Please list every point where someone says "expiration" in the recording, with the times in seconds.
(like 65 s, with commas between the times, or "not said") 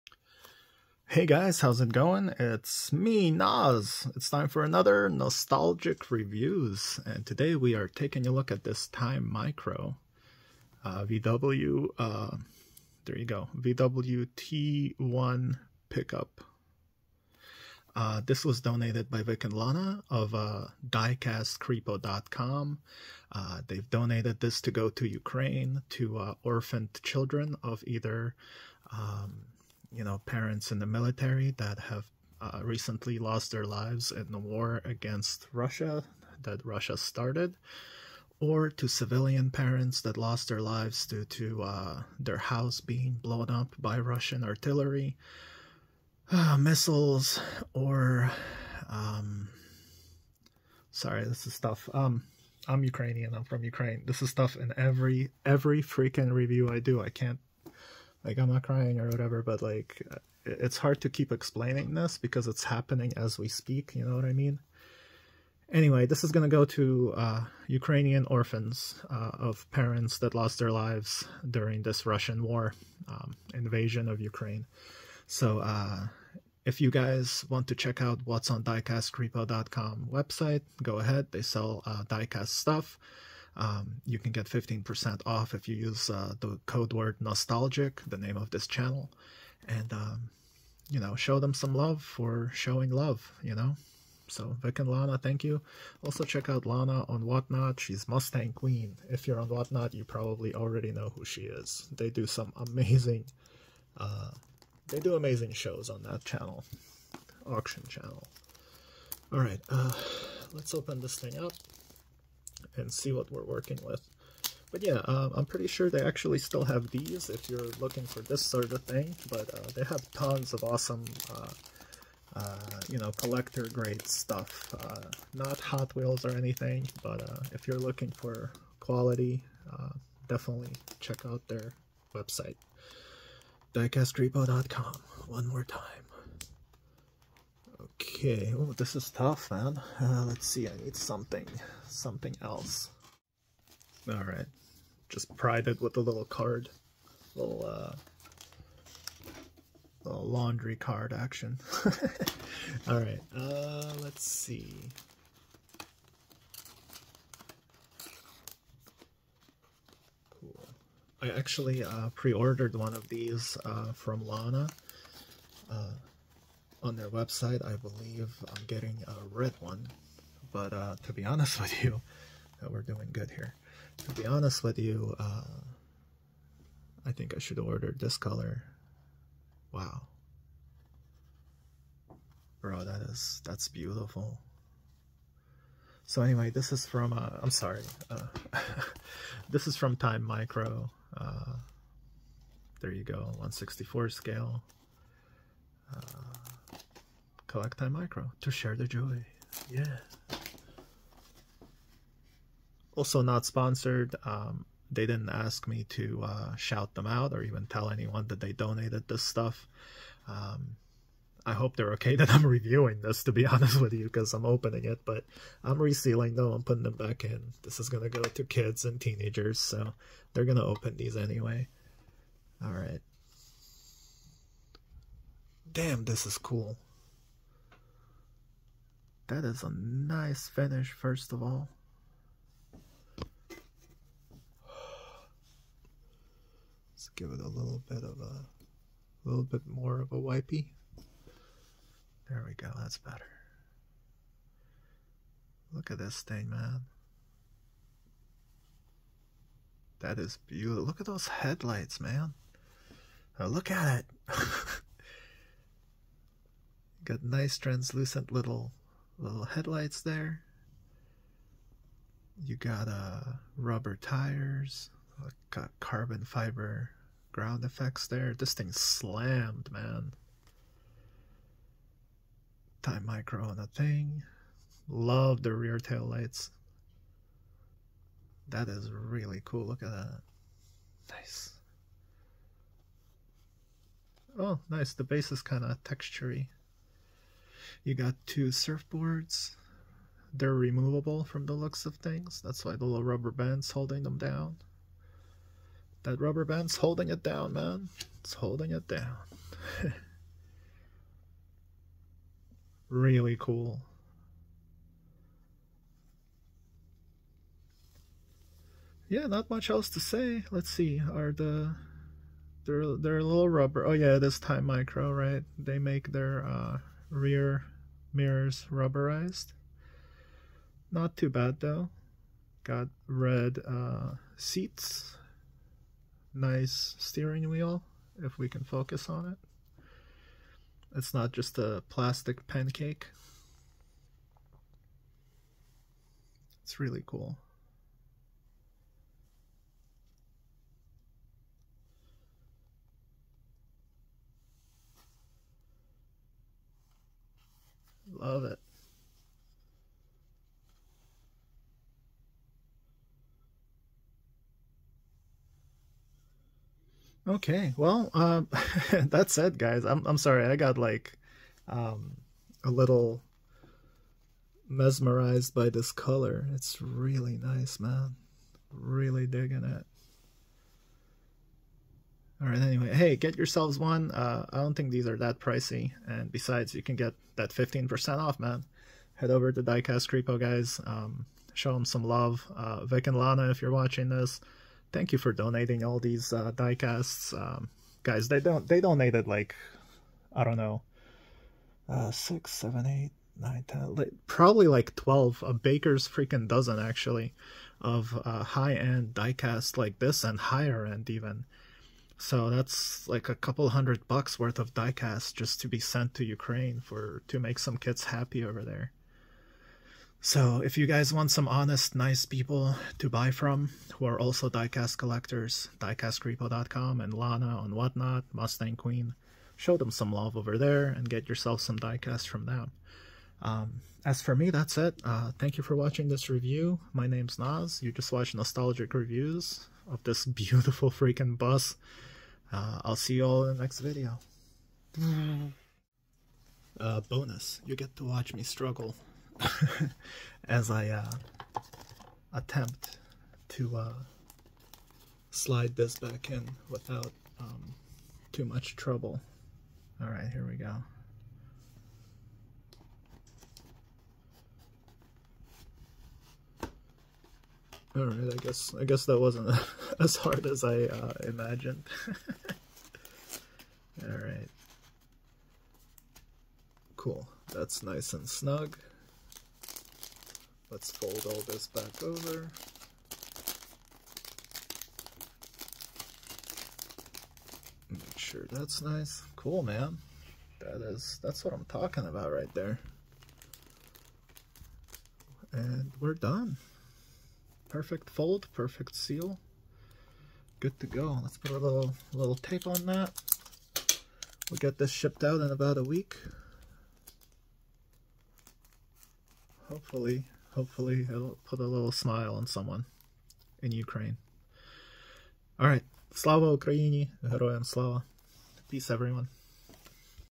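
not said.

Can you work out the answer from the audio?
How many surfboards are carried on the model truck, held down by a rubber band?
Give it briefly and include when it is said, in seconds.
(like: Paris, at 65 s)
2, at 288 s.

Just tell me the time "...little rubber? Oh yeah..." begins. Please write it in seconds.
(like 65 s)
313 s.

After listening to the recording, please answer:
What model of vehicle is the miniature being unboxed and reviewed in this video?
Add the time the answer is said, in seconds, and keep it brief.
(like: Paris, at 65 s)
VW T1 pickup, at 13 s.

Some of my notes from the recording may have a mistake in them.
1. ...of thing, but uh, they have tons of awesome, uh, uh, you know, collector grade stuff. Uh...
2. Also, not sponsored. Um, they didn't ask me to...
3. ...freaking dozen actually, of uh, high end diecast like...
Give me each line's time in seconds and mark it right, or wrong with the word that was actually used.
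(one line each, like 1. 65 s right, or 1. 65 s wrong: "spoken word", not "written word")
1. 118 s right
2. 202 s right
3. 396 s right.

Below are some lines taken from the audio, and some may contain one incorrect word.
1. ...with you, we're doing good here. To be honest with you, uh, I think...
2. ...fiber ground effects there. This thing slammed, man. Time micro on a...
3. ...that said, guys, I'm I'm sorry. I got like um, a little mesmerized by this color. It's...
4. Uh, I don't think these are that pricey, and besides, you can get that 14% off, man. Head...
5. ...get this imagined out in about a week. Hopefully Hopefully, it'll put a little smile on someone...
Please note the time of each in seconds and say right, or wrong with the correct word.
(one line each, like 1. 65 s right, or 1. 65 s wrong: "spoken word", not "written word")
1. 171 s right
2. 266 s right
3. 359 s right
4. 374 s wrong: "15", not "14"
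5. 494 s wrong: "shipped", not "imagined".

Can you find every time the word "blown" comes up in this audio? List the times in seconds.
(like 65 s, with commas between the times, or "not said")
43 s.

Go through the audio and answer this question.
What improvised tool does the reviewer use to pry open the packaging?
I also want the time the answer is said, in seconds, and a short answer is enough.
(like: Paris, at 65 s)
laundry card, at 150 s.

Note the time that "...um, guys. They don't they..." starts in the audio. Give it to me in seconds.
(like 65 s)
387 s.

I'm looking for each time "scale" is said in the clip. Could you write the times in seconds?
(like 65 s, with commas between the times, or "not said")
194 s.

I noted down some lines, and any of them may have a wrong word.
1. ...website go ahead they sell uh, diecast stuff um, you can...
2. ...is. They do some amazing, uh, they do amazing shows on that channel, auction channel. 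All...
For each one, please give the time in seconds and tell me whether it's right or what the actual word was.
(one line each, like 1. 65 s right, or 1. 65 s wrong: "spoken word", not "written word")
1. 80 s right
2. 101 s right.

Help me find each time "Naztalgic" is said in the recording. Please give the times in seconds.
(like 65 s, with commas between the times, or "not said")
5 s, 87 s, 428 s.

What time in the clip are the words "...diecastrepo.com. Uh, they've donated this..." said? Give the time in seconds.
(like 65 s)
20 s.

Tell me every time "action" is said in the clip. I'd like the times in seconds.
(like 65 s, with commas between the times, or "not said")
151 s.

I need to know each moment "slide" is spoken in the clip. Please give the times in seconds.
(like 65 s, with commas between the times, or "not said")
445 s.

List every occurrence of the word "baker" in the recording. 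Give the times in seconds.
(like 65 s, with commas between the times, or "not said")
395 s.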